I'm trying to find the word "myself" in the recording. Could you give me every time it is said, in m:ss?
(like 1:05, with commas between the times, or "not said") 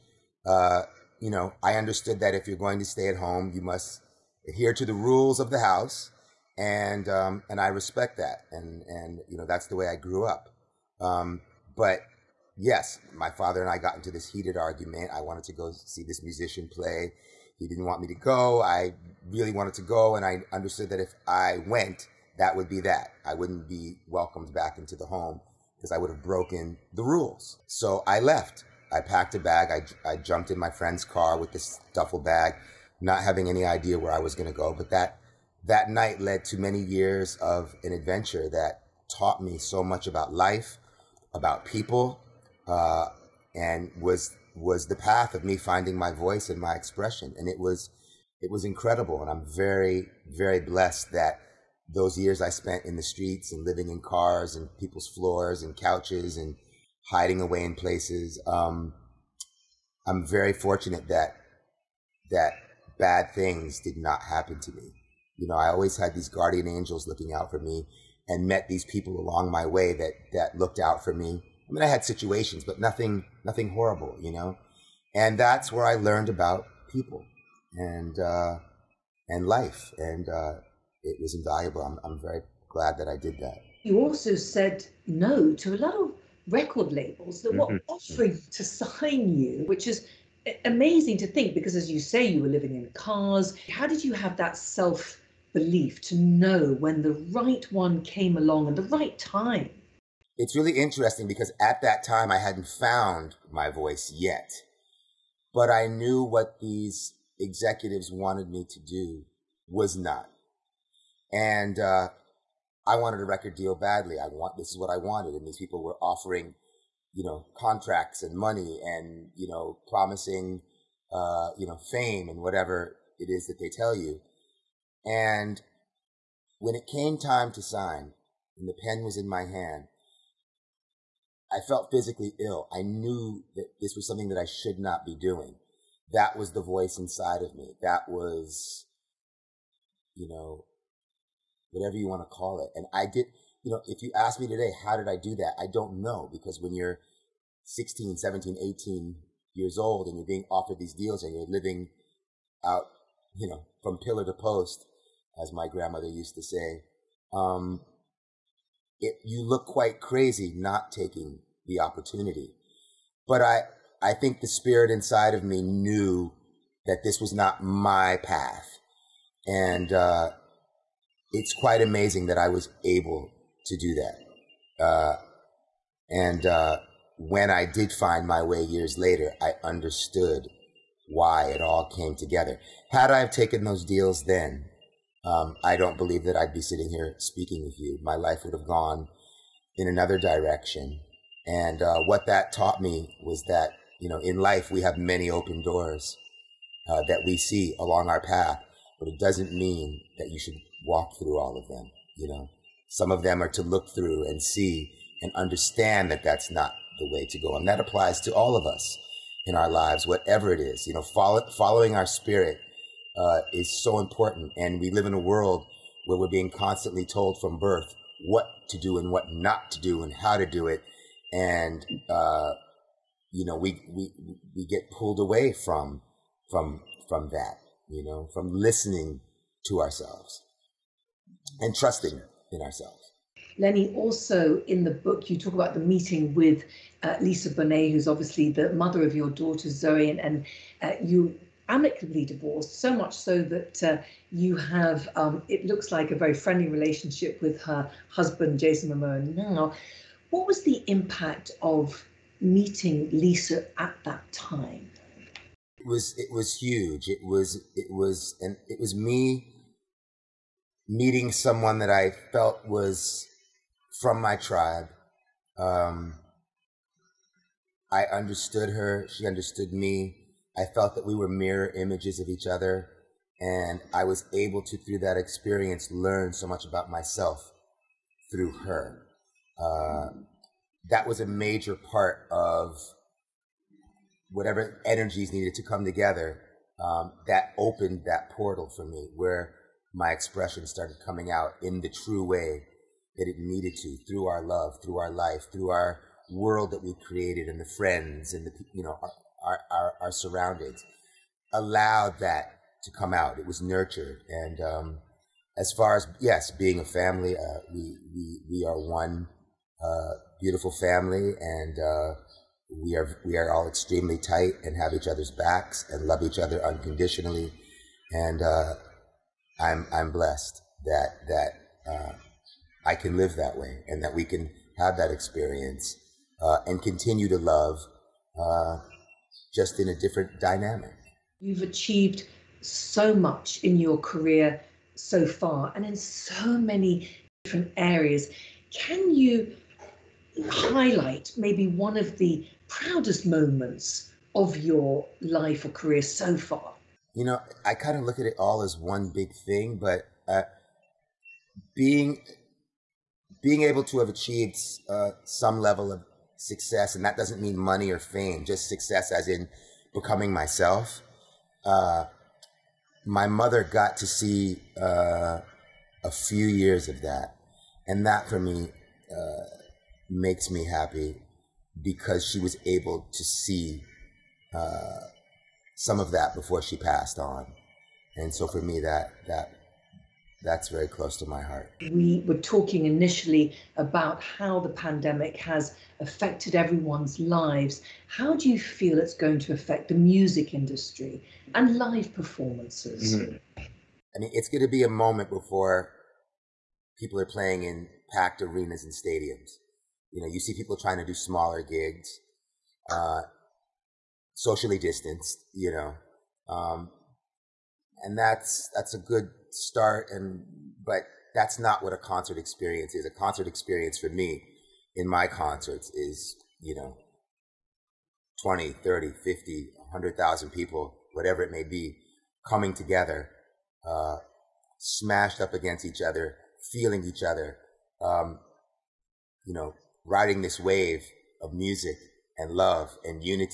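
4:36, 6:00.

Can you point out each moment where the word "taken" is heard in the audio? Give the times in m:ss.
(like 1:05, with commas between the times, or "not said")
3:03.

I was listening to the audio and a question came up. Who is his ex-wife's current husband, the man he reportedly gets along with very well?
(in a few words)
Jason Momoa.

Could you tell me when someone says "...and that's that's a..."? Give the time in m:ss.
6:48.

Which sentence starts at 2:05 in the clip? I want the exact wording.
And when it came time to sign, and the pen was in my hand, I felt physically ill.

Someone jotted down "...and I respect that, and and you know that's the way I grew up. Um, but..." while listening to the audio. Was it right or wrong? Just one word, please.
right.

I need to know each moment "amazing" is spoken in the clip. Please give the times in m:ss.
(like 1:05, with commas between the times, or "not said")
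1:30, 2:51.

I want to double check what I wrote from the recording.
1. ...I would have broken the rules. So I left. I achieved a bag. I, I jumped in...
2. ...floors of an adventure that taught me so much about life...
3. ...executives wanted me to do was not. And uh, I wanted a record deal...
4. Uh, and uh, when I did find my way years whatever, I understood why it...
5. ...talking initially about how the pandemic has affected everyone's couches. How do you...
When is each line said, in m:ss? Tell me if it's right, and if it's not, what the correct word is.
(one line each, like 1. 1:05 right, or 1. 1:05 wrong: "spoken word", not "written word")
1. 0:25 wrong: "packed", not "achieved"
2. 0:36 wrong: "years", not "floors"
3. 1:47 right
4. 2:54 wrong: "later", not "whatever"
5. 6:22 wrong: "lives", not "couches".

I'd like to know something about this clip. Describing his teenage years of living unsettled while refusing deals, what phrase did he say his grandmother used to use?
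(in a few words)
From pillar to post.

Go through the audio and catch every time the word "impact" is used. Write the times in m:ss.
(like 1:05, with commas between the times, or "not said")
4:10.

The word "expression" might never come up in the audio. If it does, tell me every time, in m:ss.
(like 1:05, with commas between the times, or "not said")
0:46, 4:50.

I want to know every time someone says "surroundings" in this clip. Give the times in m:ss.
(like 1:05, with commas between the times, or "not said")
5:00.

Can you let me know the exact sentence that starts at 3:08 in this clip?
My life would have gone in another direction.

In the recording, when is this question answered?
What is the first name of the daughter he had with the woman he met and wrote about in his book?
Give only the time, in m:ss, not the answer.
3:59.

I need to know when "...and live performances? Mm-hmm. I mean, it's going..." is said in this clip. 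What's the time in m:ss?
6:31.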